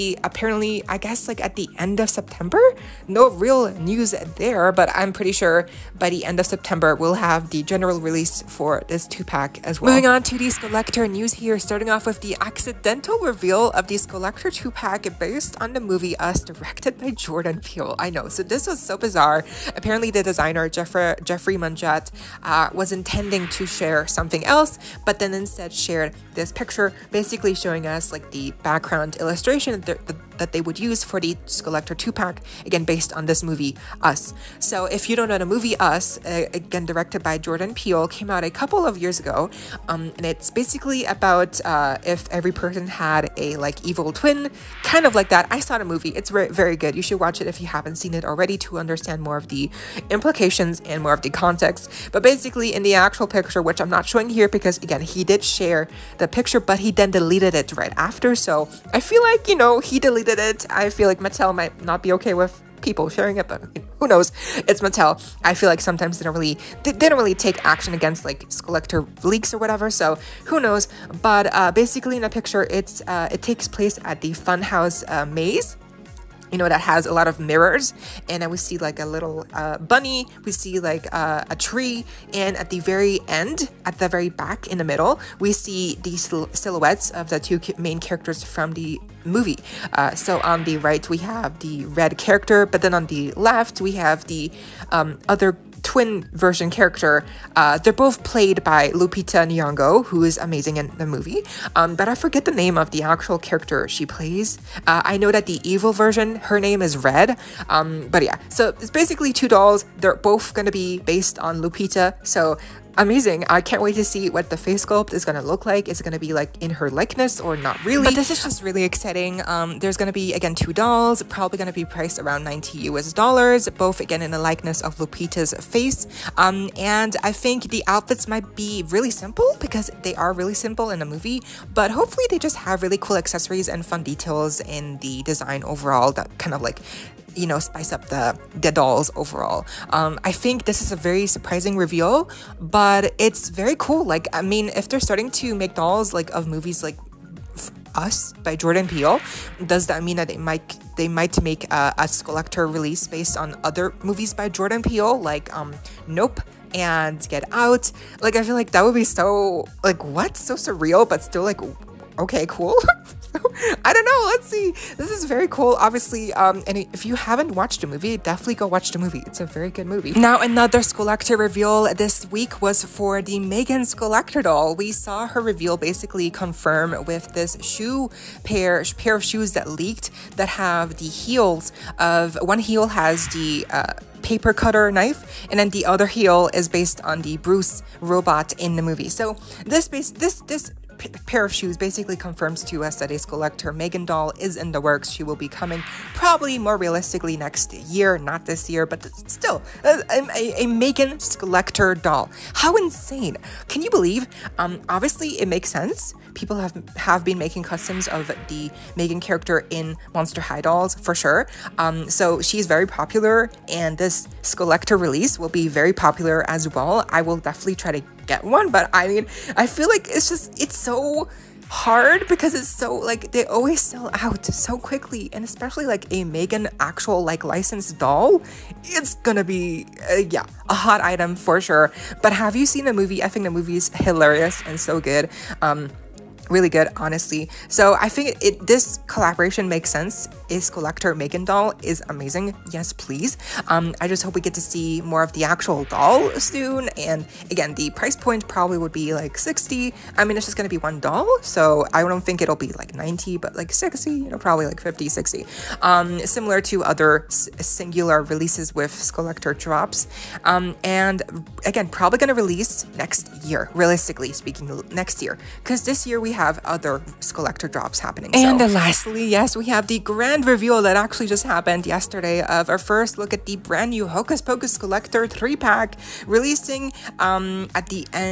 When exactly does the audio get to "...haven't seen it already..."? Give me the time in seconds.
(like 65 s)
47 s.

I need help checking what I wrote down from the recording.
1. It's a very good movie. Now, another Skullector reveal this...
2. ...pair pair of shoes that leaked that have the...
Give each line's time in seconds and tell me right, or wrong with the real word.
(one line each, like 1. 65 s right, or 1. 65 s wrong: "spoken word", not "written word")
1. 169 s right
2. 178 s right.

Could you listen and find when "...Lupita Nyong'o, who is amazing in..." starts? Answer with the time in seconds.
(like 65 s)
98 s.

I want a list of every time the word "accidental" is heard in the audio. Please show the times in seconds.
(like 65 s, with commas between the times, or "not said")
12 s.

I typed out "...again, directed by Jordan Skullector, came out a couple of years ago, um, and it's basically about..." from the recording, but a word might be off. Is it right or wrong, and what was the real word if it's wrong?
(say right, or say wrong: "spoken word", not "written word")
wrong: "Peele", not "Skullector".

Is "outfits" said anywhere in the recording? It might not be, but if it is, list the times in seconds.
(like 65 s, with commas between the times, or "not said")
127 s.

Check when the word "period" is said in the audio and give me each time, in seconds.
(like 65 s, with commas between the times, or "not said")
not said.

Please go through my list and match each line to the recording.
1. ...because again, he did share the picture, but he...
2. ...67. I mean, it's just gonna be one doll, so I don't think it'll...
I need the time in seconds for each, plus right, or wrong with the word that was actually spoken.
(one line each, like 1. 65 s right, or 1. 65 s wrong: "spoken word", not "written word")
1. 54 s right
2. 249 s wrong: "60", not "67".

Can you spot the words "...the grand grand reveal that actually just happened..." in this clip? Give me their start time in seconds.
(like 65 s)
269 s.